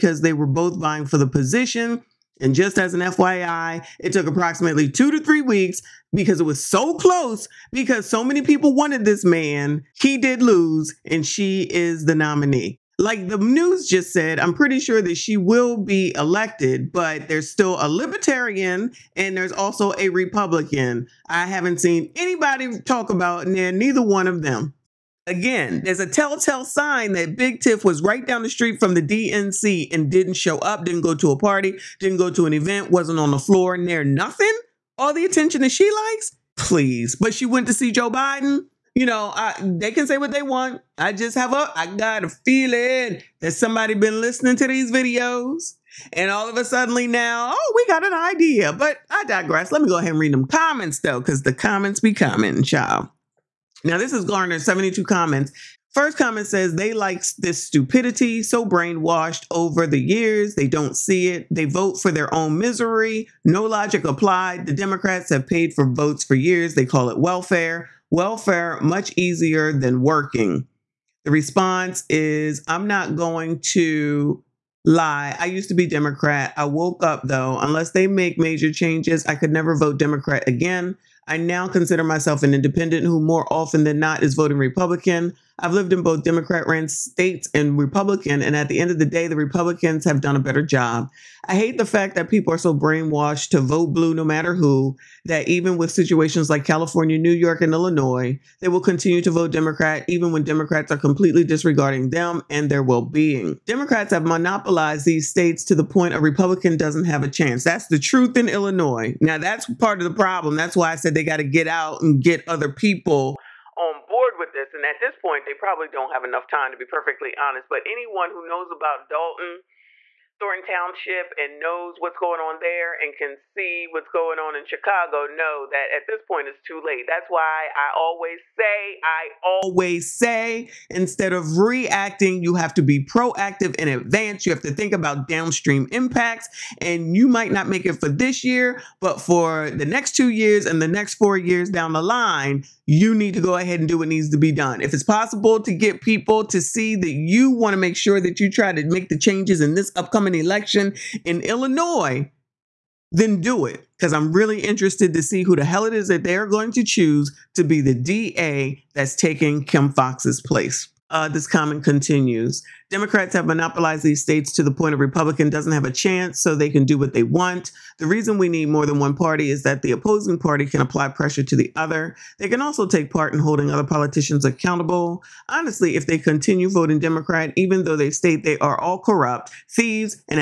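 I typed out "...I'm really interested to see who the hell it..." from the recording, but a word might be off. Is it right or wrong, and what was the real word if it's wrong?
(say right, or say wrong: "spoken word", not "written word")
right.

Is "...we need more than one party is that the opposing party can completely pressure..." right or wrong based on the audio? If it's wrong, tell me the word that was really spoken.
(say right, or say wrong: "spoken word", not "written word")
wrong: "apply", not "completely".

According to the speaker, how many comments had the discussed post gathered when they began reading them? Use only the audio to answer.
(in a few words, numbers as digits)
72.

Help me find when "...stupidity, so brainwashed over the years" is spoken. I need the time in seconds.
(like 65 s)
57 s.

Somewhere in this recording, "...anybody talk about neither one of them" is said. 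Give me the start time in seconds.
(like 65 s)
22 s.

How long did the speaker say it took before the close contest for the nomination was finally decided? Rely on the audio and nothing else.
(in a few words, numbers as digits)
2 to 3 weeks.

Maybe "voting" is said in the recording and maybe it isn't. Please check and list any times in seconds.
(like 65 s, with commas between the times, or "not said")
84 s, 176 s.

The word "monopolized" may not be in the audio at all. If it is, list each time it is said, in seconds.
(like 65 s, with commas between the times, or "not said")
104 s, 163 s.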